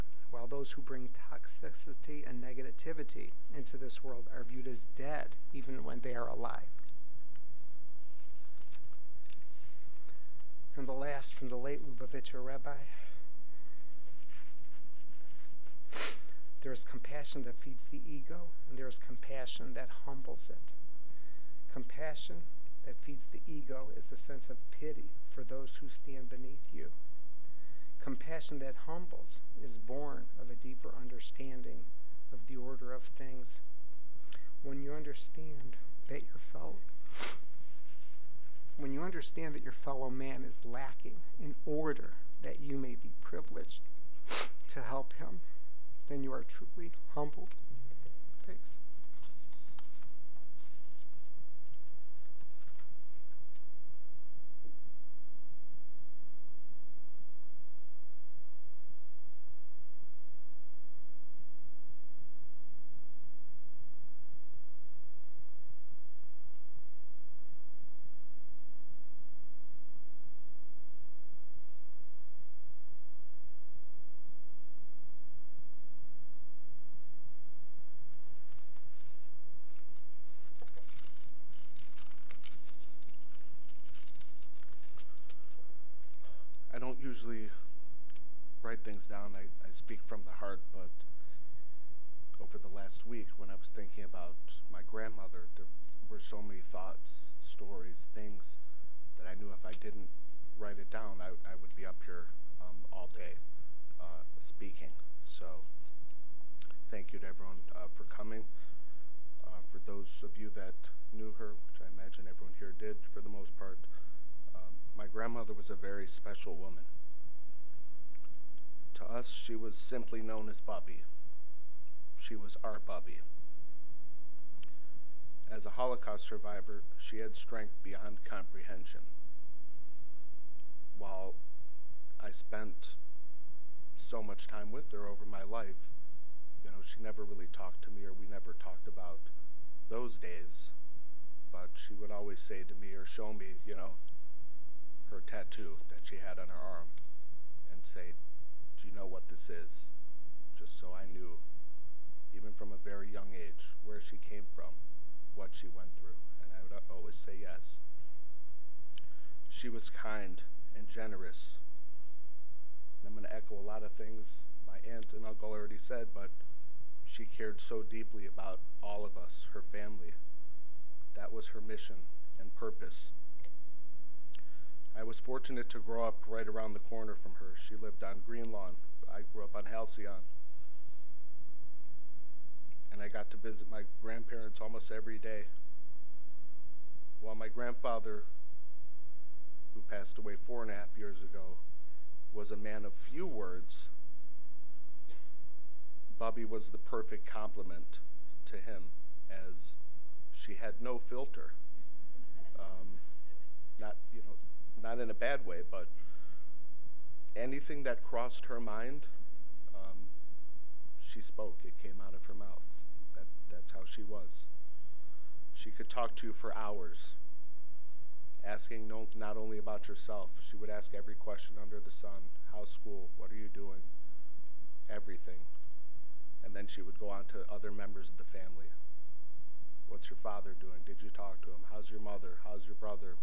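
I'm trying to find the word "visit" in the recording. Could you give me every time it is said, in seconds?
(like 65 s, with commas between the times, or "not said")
183 s.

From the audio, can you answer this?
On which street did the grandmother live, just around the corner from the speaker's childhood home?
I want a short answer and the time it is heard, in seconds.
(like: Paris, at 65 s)
Green Lawn, at 178 s.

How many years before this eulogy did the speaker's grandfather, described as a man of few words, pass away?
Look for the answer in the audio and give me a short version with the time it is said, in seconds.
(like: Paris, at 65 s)
4 and a half, at 190 s.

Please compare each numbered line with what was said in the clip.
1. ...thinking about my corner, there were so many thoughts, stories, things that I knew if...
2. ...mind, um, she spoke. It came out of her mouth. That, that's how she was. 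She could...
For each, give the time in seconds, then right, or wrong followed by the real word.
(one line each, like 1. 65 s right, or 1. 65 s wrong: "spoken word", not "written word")
1. 93 s wrong: "grandmother", not "corner"
2. 208 s right.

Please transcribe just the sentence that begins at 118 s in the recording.
To us, she was simply known as Bubby.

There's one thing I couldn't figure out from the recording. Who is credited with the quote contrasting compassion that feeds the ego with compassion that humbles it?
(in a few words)
Lubavitcher Rabbi.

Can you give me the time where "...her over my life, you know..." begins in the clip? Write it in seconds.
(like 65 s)
134 s.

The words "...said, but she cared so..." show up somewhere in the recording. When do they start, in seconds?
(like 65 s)
165 s.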